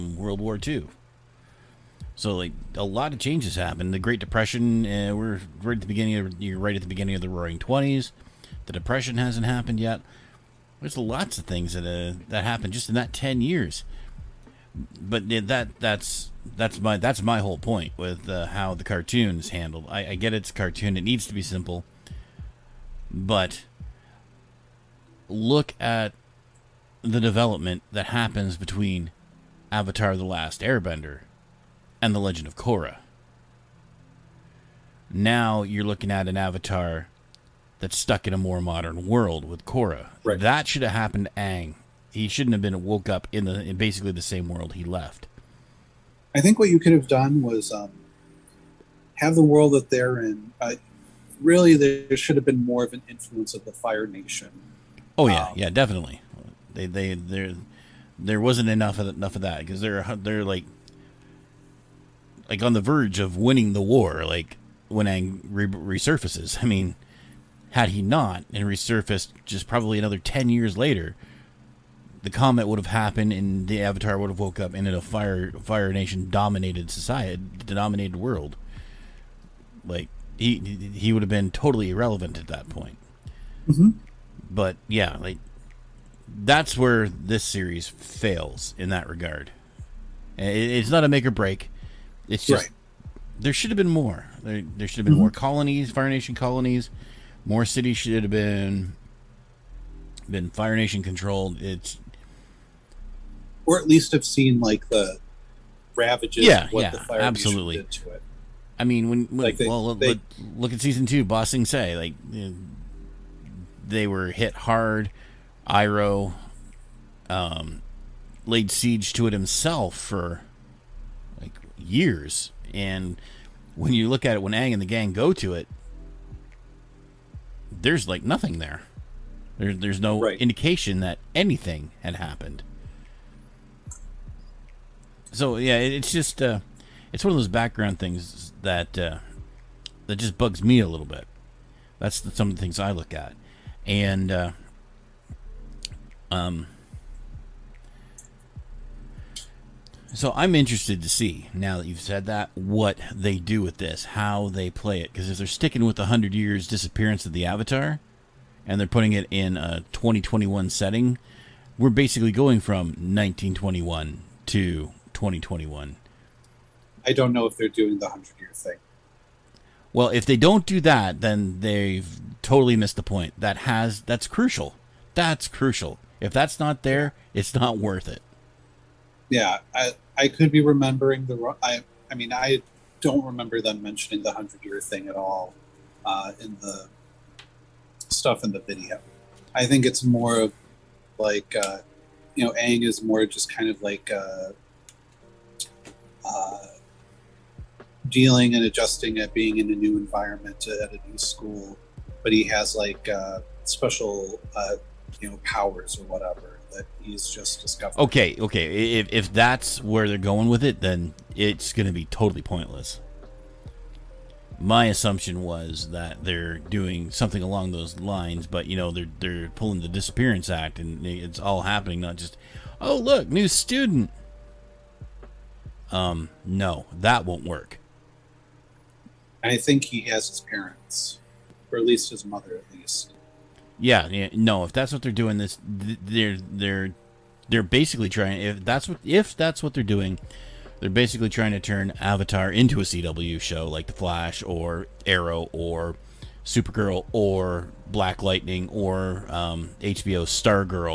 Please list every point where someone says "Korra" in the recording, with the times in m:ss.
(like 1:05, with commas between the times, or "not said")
0:32, 0:39.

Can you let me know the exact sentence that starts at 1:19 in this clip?
Like he he would have been totally irrelevant at that point.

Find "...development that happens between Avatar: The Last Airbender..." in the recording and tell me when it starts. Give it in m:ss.
0:27.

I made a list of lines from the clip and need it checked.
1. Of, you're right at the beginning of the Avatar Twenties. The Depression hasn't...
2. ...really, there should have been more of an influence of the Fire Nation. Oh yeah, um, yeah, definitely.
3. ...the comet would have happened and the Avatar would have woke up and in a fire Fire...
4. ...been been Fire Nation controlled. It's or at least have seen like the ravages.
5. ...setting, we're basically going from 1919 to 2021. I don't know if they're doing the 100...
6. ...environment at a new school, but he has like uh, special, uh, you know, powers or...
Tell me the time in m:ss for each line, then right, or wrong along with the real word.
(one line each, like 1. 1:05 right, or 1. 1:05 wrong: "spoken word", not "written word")
1. 0:06 wrong: "Roaring", not "Avatar"
2. 0:51 right
3. 1:12 right
4. 1:38 right
5. 2:40 wrong: "1921", not "1919"
6. 3:19 right.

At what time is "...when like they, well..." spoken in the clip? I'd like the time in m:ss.
1:49.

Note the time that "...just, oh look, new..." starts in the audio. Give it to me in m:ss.
3:42.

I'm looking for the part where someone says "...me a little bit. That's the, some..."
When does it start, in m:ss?
2:20.